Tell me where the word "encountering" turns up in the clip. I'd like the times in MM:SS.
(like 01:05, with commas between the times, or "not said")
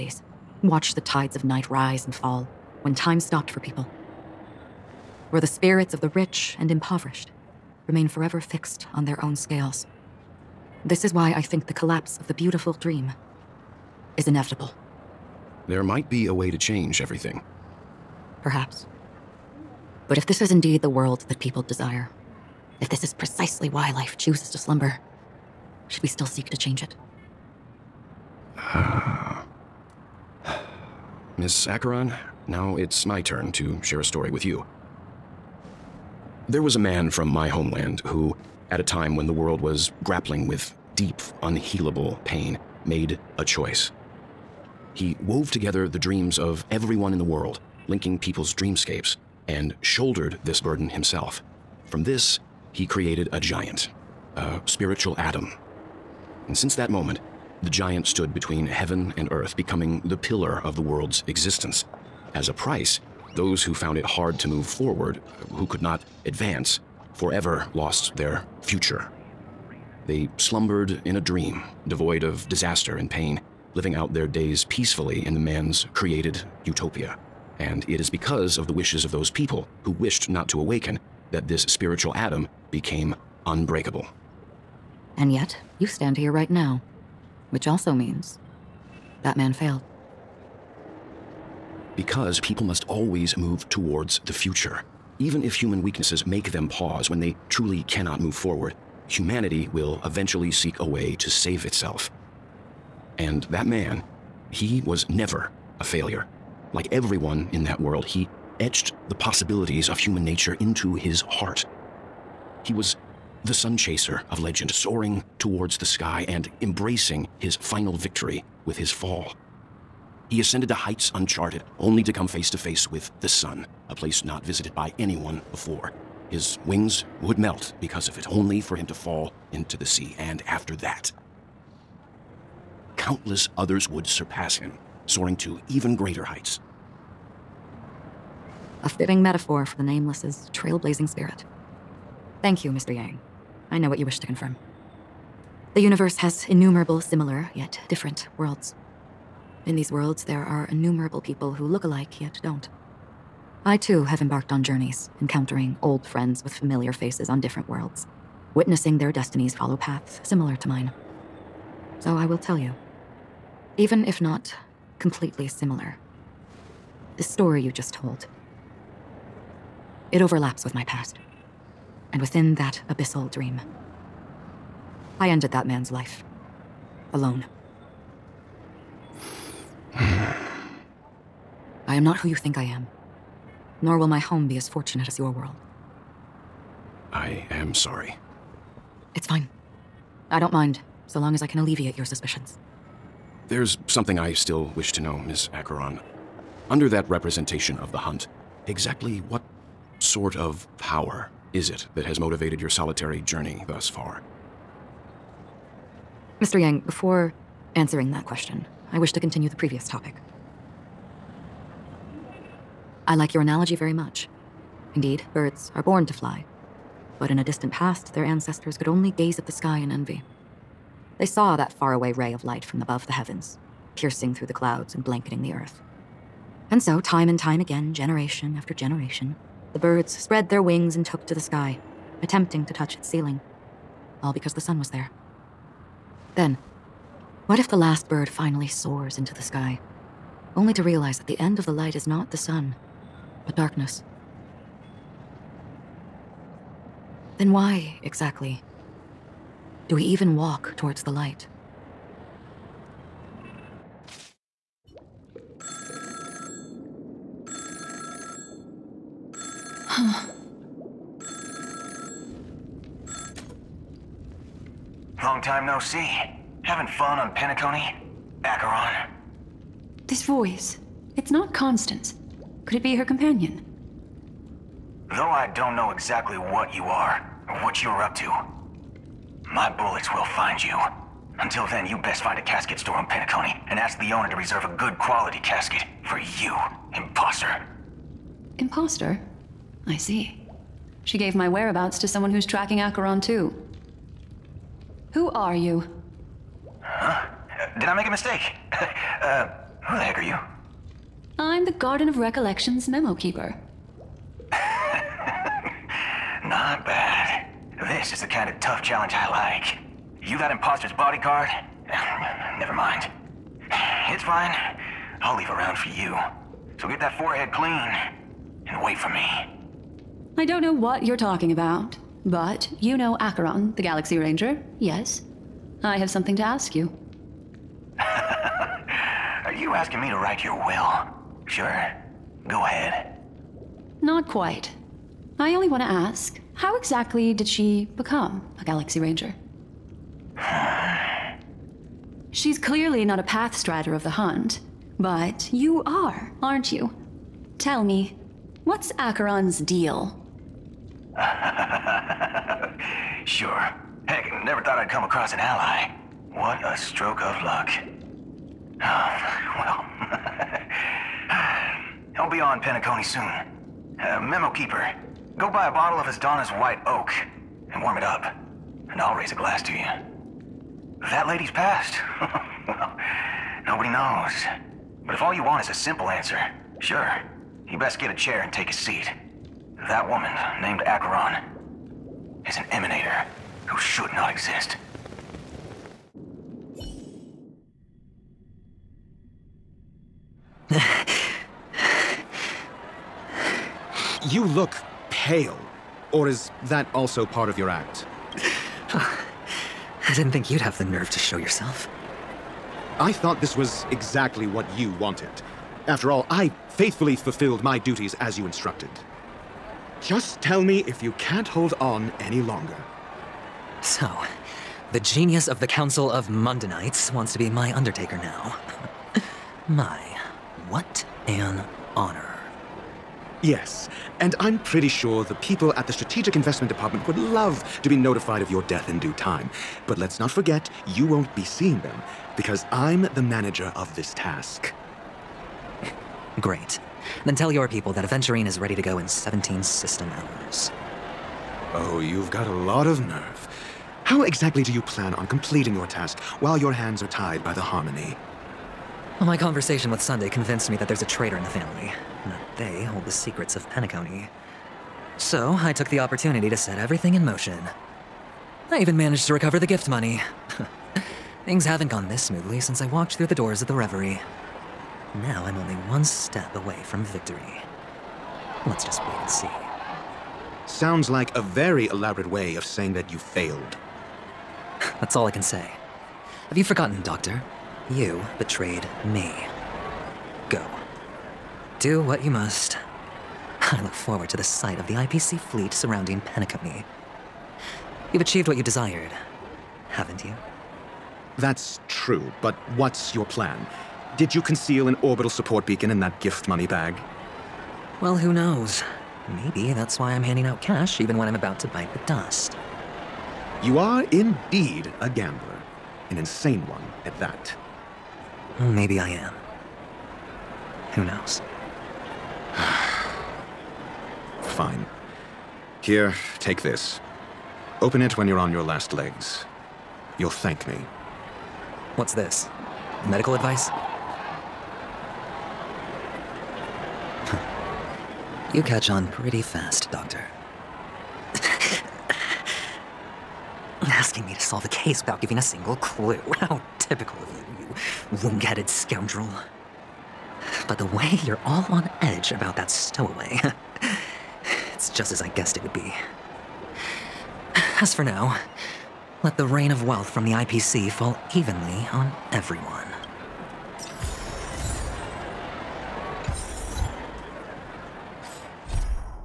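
02:35.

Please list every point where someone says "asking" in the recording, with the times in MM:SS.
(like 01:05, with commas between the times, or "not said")
05:29, 08:53.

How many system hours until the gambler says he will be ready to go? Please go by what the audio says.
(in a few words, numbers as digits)
17.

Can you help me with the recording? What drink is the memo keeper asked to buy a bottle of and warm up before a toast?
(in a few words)
White Oak.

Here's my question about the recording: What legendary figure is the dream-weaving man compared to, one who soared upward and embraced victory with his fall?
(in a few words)
The sun chaser.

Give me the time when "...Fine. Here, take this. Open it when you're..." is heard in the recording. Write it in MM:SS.
08:34.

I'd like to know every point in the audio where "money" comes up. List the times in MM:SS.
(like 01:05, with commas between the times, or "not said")
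07:39, 08:16.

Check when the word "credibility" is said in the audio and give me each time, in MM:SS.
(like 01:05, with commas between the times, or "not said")
not said.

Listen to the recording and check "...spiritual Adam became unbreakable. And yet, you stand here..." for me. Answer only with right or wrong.
right.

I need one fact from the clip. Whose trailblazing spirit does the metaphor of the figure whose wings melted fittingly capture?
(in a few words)
The Nameless.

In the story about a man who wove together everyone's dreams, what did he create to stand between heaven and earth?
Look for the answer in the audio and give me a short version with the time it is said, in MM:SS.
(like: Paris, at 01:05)
A spiritual Adam, at 00:54.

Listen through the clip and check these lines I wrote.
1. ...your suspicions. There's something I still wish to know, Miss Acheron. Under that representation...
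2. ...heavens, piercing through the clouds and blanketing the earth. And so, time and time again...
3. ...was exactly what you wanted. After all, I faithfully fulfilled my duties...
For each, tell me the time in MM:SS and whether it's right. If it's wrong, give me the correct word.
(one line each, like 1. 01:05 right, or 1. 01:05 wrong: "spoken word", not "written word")
1. 03:11 right
2. 03:43 right
3. 06:43 right.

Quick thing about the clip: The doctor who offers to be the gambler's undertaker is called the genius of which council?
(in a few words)
Council of Mundanites.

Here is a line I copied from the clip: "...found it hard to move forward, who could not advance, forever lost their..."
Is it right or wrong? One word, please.
right.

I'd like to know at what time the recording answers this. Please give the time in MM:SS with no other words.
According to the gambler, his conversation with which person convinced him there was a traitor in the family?
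07:30.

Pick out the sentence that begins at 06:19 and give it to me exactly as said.
That woman, named Acheron, is an emanator who should not exist.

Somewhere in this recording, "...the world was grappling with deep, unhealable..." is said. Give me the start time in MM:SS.
00:39.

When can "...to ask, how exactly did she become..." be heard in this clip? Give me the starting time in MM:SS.
05:35.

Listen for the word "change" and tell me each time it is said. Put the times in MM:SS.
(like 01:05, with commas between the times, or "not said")
00:16, 00:26.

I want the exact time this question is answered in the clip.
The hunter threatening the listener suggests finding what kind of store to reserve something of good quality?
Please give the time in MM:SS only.
04:42.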